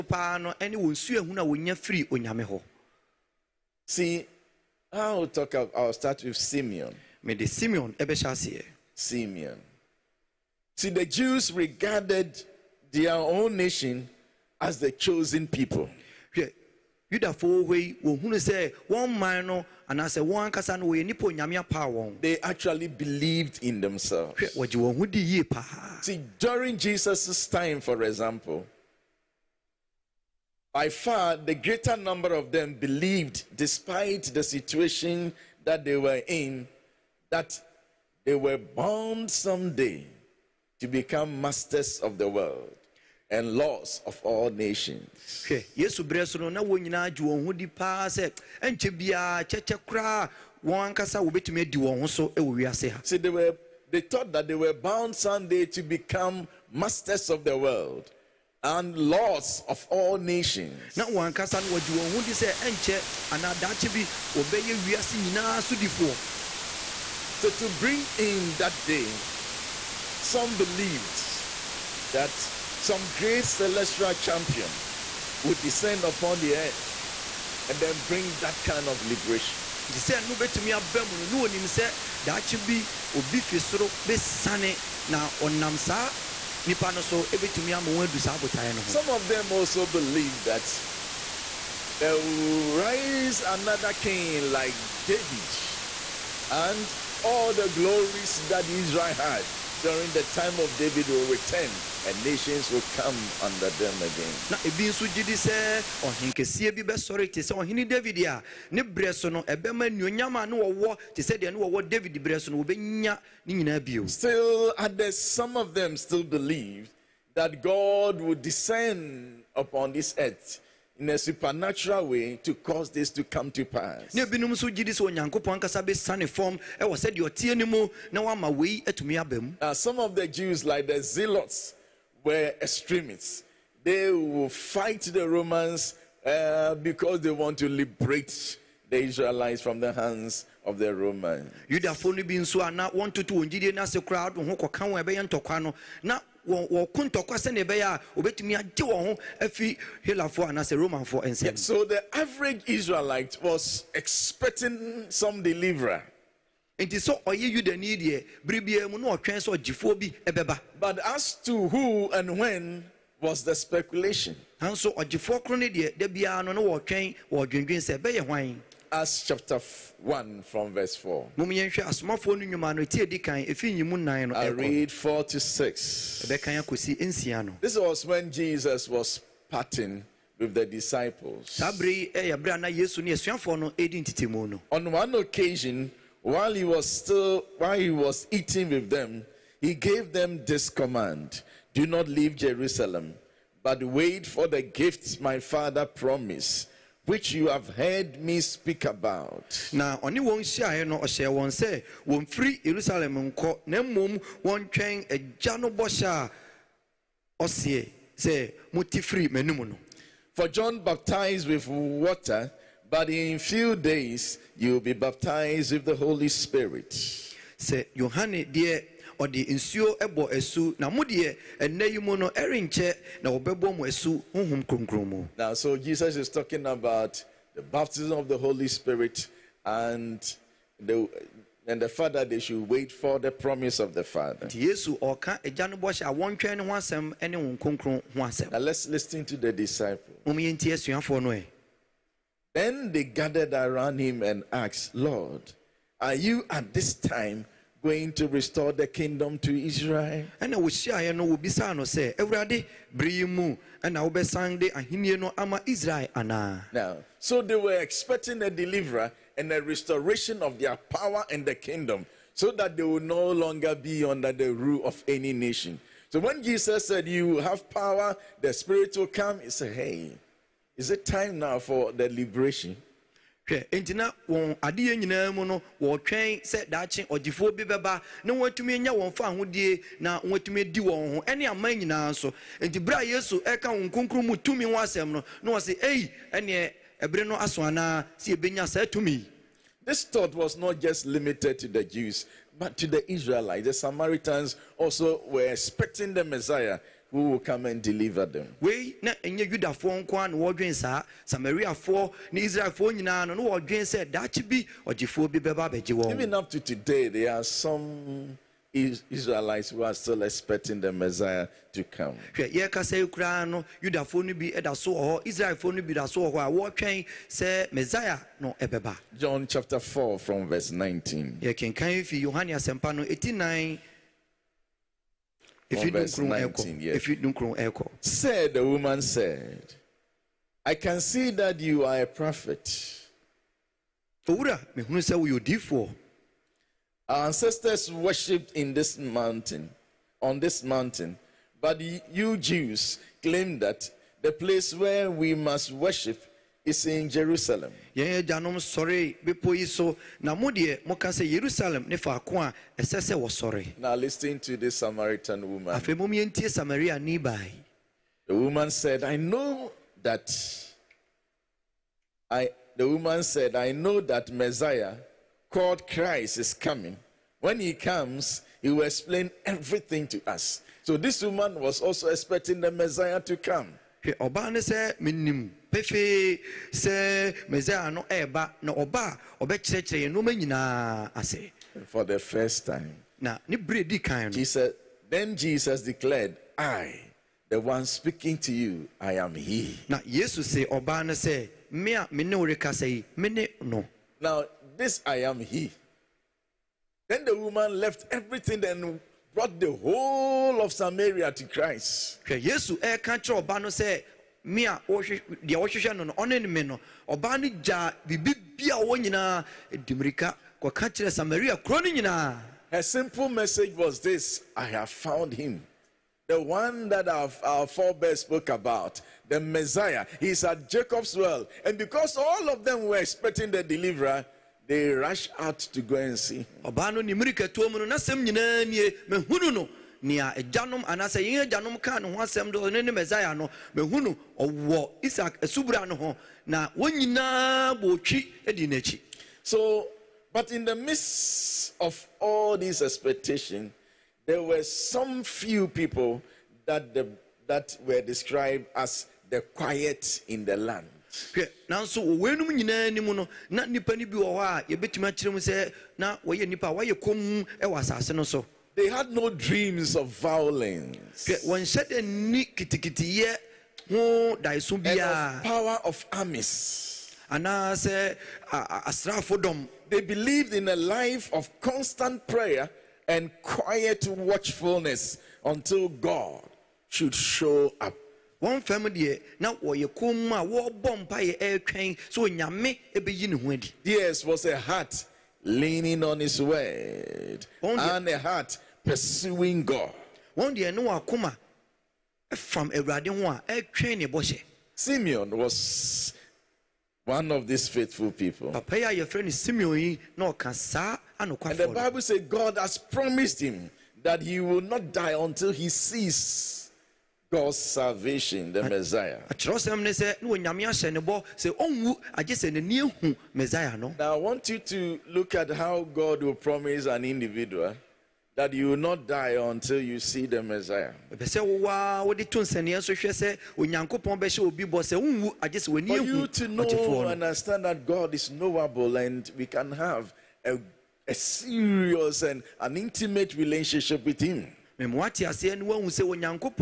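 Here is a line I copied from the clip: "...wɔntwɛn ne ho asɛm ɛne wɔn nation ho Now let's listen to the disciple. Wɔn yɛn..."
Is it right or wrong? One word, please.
wrong.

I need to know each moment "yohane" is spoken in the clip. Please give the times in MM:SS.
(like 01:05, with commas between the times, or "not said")
03:37, 05:22.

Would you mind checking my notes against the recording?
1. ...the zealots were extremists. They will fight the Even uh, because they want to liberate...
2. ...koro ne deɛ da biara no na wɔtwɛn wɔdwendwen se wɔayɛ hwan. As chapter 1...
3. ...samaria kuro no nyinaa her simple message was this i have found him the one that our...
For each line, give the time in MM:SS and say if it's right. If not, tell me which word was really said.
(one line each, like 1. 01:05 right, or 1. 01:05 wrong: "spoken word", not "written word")
1. 02:10 wrong: "Romans", not "Even"
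2. 02:45 wrong: "ɛbɛyɛ", not "wɔayɛ"
3. 06:51 right.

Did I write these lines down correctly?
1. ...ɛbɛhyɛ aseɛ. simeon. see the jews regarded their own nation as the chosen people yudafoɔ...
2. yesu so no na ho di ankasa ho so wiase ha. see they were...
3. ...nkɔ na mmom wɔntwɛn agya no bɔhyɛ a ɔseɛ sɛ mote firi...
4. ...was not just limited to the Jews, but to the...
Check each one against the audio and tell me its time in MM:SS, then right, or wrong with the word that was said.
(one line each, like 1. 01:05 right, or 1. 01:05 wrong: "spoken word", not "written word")
1. 00:07 right
2. 00:45 right
3. 03:23 right
4. 04:50 right.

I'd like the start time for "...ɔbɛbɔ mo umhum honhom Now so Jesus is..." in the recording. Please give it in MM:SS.
03:43.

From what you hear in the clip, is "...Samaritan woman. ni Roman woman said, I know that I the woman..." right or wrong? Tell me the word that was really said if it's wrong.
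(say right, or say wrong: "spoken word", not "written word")
wrong: "The", not "Roman".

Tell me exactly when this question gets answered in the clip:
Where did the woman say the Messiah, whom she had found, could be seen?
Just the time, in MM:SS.
07:00.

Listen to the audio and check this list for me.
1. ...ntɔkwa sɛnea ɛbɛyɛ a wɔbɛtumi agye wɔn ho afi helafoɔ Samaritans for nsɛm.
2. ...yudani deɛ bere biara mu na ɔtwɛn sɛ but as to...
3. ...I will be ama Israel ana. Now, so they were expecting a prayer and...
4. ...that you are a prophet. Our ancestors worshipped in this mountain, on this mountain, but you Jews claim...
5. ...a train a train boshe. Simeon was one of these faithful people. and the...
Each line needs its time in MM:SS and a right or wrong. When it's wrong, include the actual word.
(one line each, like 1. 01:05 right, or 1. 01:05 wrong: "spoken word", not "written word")
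1. 02:26 wrong: "Roman", not "Samaritans"
2. 02:37 right
3. 04:11 wrong: "deliverer", not "prayer"
4. 05:31 right
5. 08:12 wrong: "radin", not "train".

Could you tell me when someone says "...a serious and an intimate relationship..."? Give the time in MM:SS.
08:51.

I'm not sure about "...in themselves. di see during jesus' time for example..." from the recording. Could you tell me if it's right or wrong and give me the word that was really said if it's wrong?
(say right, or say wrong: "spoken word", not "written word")
right.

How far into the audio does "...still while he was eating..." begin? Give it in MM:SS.
03:06.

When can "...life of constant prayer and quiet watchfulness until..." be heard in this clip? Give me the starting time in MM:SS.
07:50.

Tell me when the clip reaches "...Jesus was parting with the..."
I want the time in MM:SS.
02:58.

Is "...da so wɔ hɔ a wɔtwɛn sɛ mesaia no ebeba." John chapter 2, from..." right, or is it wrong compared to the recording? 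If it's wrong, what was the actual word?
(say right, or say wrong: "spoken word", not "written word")
wrong: "4", not "2".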